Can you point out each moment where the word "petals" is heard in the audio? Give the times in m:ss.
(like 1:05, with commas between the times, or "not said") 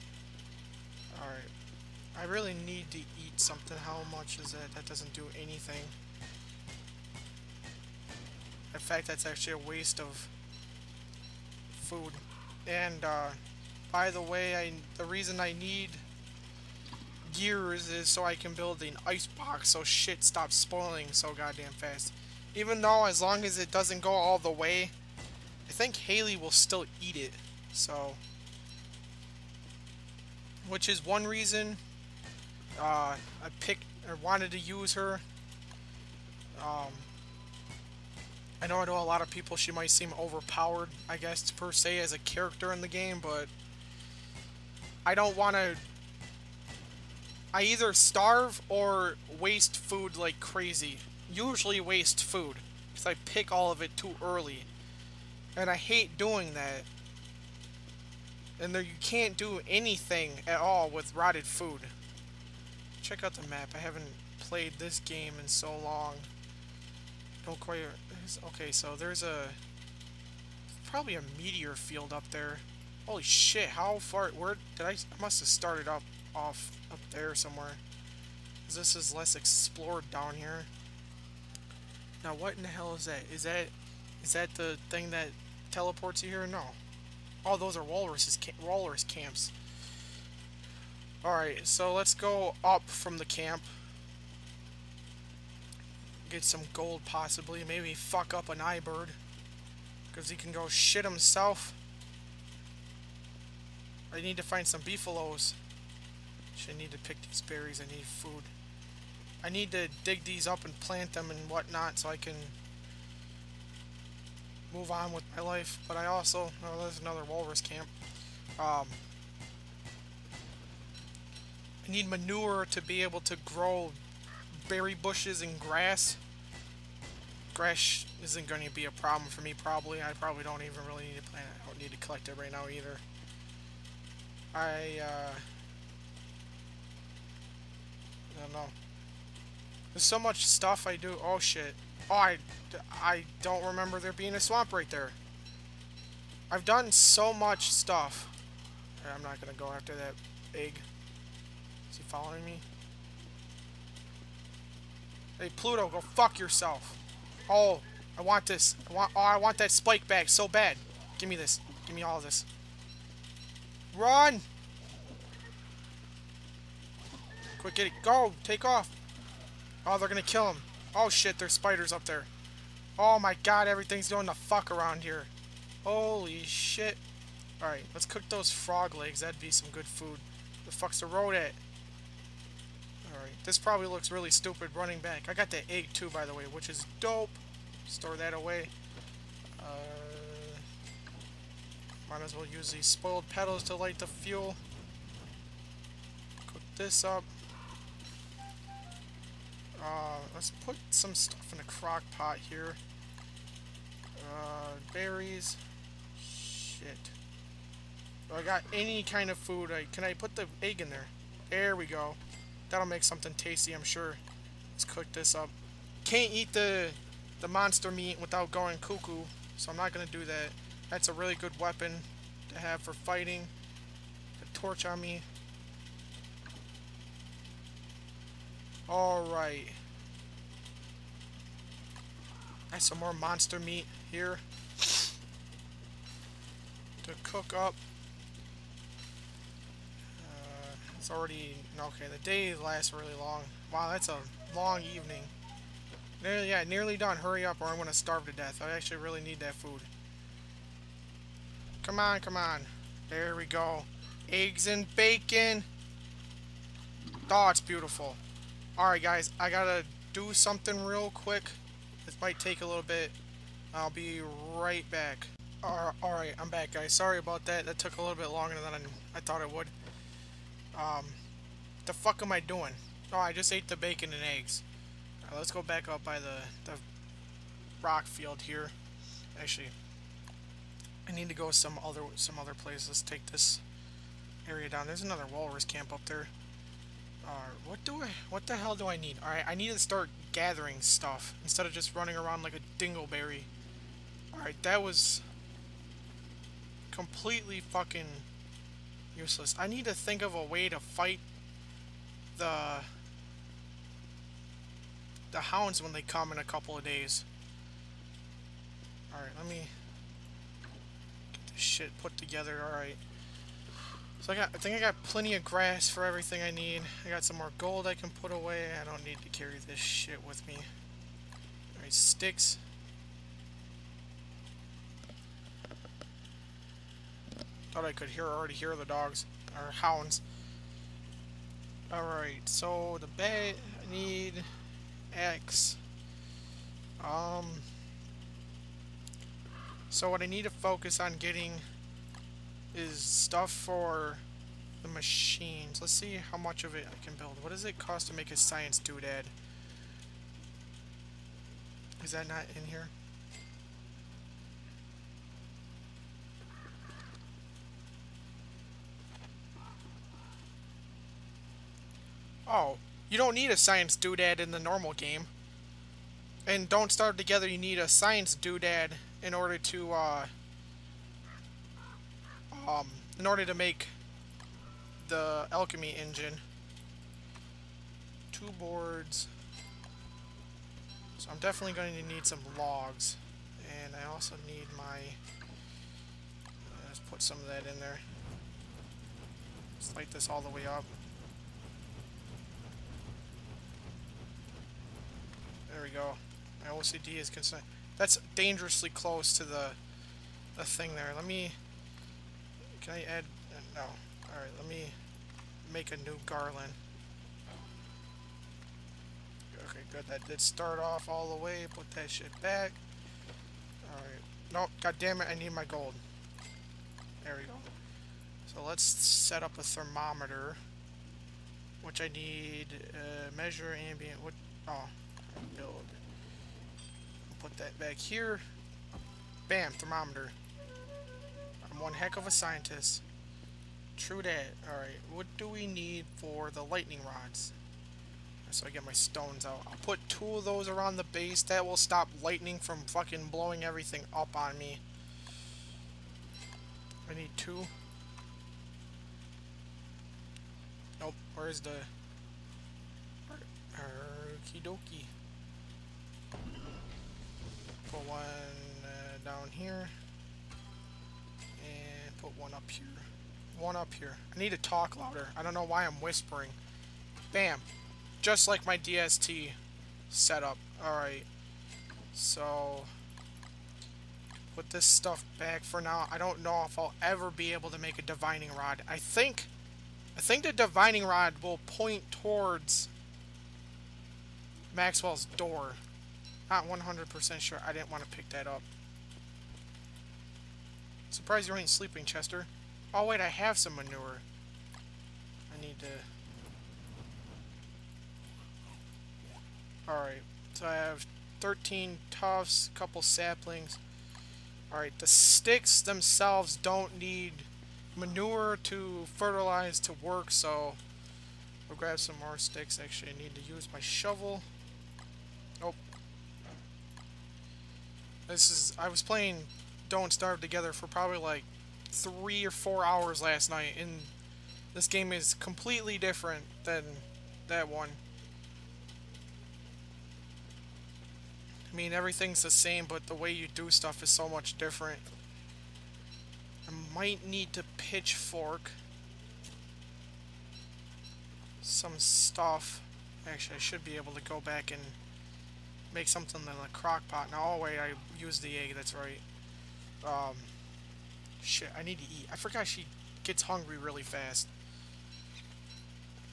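3:13.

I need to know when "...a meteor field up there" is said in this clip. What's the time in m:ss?
1:11.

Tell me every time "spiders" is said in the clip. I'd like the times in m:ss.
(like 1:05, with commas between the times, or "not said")
2:51.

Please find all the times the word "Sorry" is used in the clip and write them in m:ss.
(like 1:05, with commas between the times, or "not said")
4:26.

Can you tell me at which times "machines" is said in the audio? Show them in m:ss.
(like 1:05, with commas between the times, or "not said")
5:44.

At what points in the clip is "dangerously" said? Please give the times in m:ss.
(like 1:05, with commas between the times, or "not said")
6:38.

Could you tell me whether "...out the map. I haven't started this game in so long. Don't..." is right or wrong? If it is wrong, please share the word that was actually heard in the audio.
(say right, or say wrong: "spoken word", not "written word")
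wrong: "played", not "started".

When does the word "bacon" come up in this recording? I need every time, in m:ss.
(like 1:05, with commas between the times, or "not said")
4:14, 4:33.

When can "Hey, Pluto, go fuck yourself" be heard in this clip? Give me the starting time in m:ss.
2:35.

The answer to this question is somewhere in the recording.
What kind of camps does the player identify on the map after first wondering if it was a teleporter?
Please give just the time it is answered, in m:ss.
1:28.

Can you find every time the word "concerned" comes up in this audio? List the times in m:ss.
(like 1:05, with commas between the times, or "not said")
6:37.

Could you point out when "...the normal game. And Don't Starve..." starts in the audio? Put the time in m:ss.
6:04.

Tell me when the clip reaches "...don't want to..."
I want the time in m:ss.
0:45.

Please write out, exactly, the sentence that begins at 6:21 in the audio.
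So I'm definitely going to need some logs.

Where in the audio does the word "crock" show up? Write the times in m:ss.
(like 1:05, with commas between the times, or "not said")
3:21, 9:06.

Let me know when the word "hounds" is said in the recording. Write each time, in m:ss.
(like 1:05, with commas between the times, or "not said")
5:05, 5:29.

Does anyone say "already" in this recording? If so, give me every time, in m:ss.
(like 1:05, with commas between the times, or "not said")
4:01, 5:28.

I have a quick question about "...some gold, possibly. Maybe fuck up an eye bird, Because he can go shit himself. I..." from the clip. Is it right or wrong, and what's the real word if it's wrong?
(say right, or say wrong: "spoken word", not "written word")
right.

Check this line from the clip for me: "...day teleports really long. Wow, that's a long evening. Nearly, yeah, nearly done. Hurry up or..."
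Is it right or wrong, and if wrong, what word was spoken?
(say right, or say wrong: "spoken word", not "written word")
wrong: "lasts", not "teleports".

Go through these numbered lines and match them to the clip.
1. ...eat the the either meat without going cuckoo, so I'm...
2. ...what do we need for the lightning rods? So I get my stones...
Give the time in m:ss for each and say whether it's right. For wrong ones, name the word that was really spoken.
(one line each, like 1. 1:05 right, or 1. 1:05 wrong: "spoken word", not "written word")
1. 3:36 wrong: "monster", not "either"
2. 7:15 right.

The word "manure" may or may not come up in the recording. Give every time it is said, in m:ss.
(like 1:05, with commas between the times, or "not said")
2:02, 8:13, 8:27.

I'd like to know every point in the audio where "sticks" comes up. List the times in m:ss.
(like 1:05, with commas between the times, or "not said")
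5:21, 8:25, 8:32.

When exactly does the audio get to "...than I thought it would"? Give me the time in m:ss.
4:28.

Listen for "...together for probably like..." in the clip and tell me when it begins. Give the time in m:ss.
8:40.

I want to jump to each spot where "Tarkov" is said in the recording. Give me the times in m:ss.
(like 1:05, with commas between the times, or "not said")
not said.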